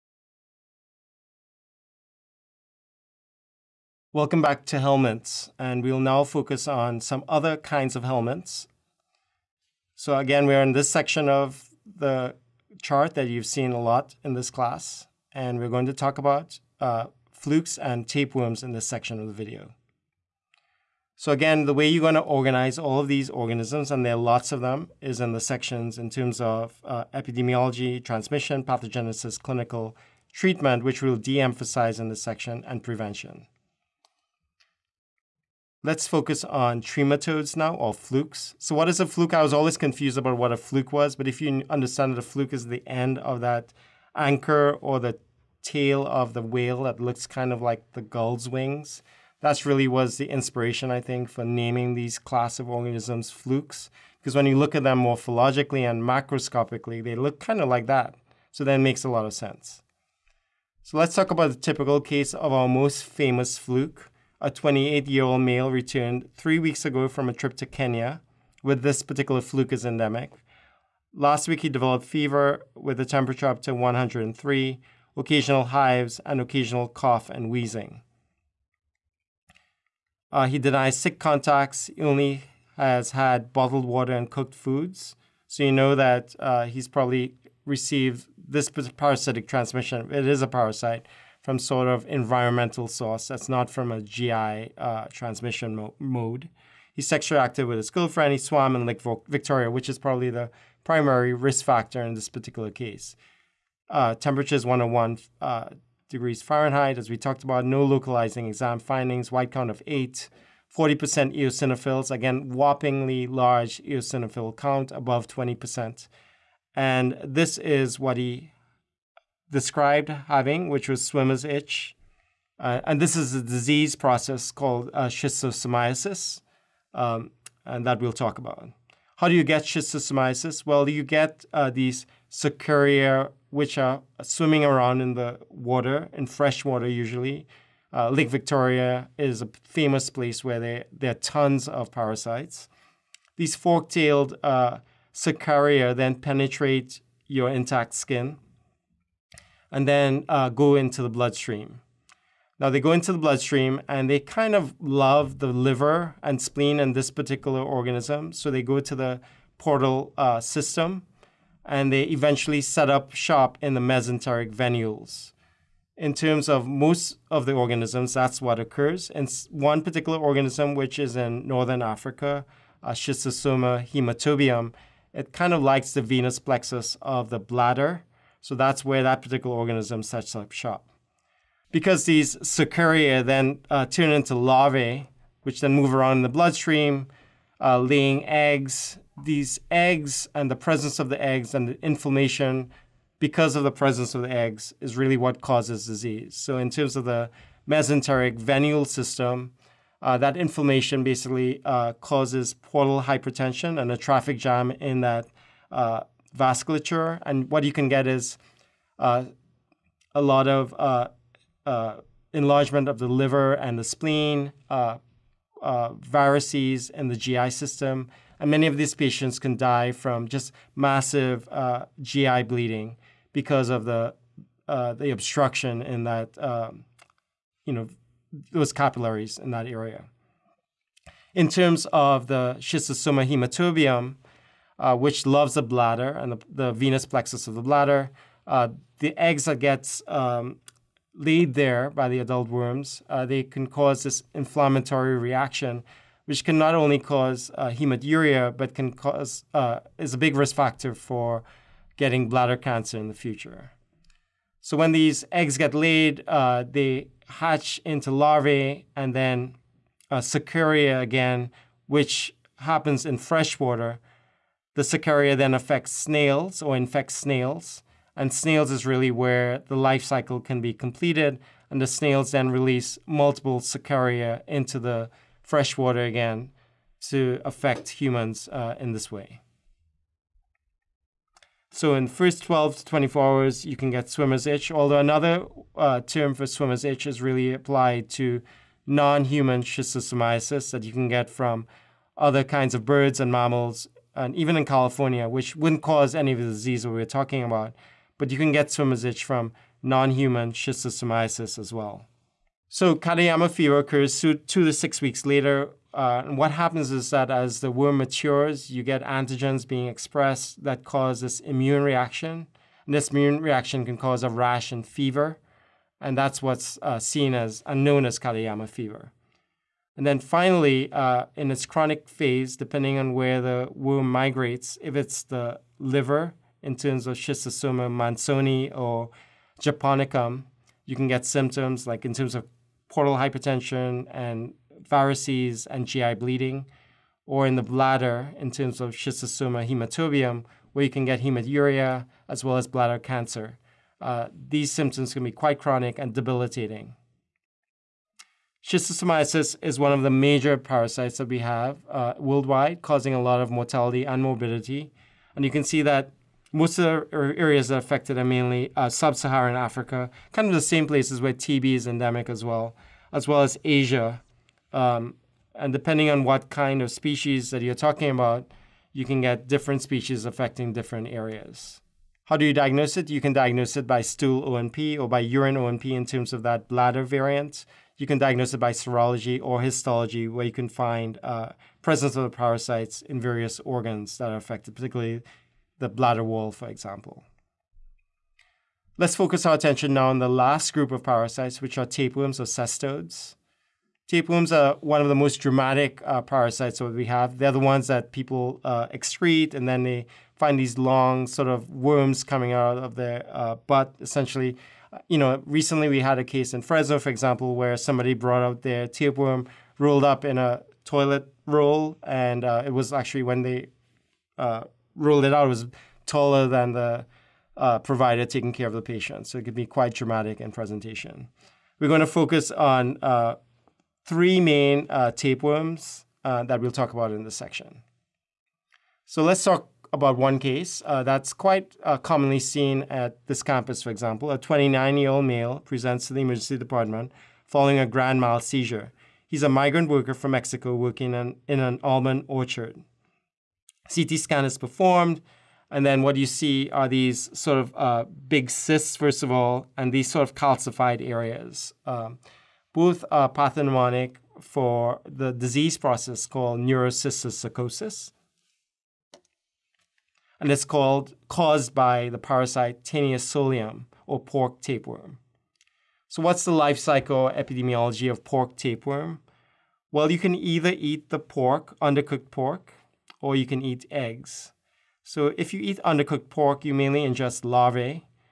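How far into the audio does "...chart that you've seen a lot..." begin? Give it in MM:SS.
00:12.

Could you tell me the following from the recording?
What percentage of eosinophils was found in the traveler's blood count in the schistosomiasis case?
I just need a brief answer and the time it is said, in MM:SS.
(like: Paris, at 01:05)
40%, at 01:50.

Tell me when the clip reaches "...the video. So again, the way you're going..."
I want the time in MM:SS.
00:19.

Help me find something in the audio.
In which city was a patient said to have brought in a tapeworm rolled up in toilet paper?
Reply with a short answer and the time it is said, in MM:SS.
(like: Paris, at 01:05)
Fresno, at 06:46.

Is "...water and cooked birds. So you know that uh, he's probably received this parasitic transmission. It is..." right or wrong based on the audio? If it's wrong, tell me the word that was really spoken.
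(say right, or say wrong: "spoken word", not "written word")
wrong: "foods", not "birds".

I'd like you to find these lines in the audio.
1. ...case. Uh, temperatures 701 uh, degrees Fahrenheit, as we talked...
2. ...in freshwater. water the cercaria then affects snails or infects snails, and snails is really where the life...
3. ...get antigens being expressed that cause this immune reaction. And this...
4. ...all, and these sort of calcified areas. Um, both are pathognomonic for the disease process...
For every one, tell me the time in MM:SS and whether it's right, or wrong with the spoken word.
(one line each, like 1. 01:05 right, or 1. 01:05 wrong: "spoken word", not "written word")
1. 01:42 wrong: "101", not "701"
2. 04:23 right
3. 05:08 right
4. 07:29 right.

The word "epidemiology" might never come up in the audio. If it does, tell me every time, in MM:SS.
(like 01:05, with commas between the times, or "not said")
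00:27, 07:47.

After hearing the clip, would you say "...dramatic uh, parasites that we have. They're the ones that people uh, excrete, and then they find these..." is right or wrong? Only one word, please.
right.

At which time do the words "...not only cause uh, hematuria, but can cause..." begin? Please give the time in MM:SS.
04:06.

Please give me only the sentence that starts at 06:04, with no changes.
Um, and depending on what kind of species that you're talking about, you can get different species affecting different areas.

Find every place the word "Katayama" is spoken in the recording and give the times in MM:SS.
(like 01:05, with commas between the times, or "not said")
05:02, 05:18.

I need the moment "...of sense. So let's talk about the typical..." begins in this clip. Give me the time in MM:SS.
00:59.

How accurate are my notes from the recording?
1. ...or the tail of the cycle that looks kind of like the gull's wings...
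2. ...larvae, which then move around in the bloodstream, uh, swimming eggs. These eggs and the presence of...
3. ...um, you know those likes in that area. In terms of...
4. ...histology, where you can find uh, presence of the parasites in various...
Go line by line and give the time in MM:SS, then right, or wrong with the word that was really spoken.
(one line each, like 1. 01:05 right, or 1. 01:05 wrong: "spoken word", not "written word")
1. 00:44 wrong: "whale", not "cycle"
2. 03:04 wrong: "laying", not "swimming"
3. 03:46 wrong: "capillaries", not "likes"
4. 06:19 right.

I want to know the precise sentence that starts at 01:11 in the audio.
Last week, he developed fever with a temperature up to 103, occasional hives, and occasional cough and wheezing.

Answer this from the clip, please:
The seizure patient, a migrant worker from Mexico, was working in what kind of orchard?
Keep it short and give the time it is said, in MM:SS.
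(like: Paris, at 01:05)
Almond orchard, at 07:21.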